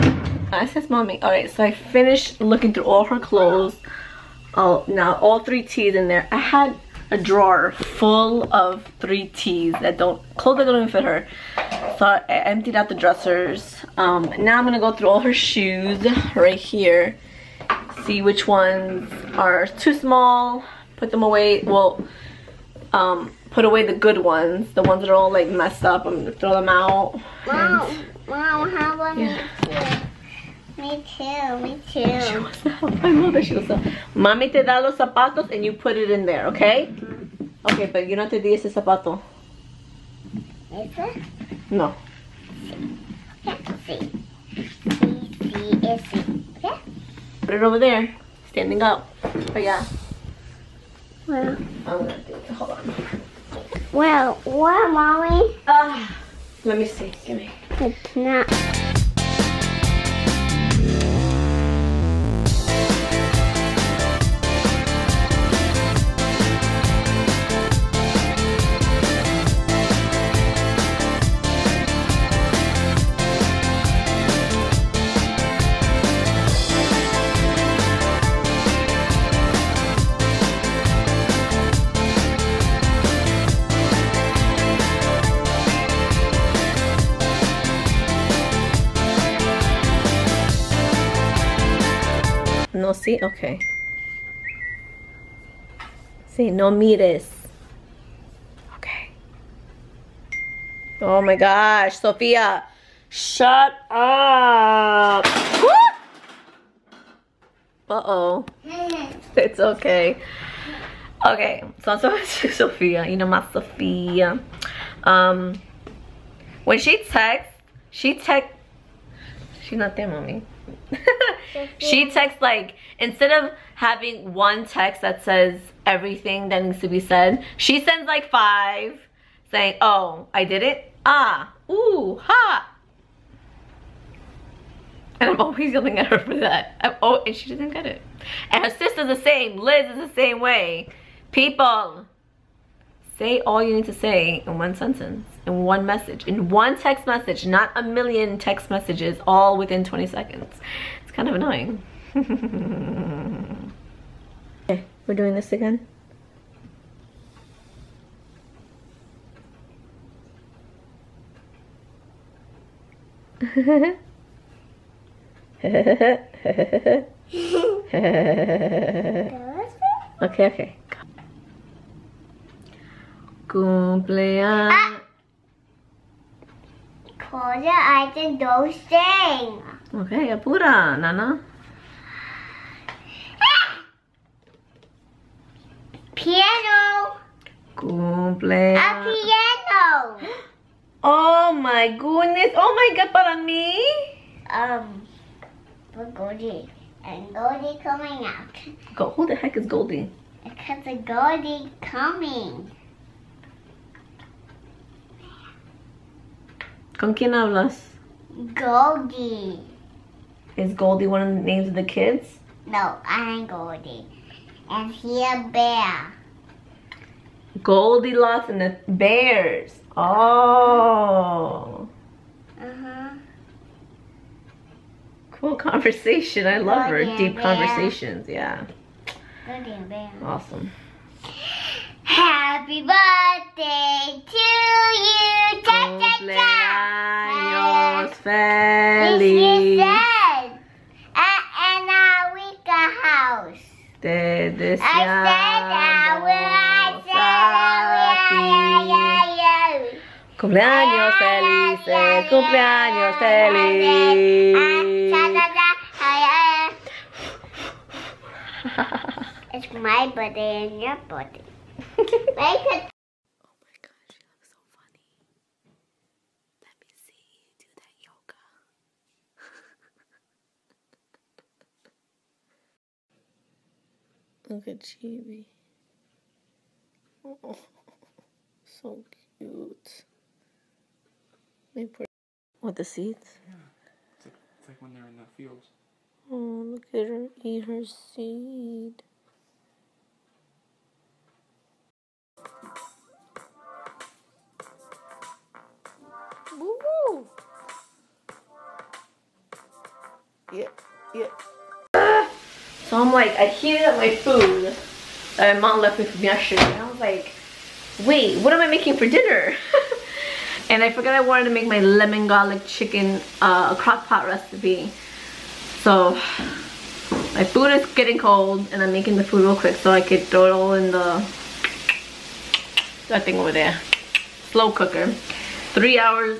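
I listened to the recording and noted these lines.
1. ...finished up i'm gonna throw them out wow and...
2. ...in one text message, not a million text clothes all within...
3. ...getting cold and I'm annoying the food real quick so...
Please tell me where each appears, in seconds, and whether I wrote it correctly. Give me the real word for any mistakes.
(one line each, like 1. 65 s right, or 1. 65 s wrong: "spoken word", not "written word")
1. 25 s wrong: "messed", not "finished"
2. 146 s wrong: "messages", not "clothes"
3. 317 s wrong: "making", not "annoying".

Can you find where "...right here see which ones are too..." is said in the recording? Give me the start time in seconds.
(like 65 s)
16 s.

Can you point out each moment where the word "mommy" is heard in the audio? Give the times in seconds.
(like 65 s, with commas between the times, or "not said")
0 s, 34 s, 54 s, 120 s.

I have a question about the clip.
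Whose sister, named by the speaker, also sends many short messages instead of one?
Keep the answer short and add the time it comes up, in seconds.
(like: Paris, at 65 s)
Liz, at 139 s.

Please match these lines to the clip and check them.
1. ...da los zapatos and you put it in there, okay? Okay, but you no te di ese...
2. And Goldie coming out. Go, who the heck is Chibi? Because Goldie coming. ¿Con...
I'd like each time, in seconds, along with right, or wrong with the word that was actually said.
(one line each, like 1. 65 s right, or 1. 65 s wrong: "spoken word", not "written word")
1. 34 s right
2. 197 s wrong: "Goldie", not "Chibi".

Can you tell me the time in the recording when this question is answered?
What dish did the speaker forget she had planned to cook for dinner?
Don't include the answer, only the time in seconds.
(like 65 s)
311 s.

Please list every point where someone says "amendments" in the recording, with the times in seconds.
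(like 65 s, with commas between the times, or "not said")
not said.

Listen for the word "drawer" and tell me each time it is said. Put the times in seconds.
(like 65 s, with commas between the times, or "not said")
7 s.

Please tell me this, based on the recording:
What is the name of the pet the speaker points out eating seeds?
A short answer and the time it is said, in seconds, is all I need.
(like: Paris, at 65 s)
Chibi, at 274 s.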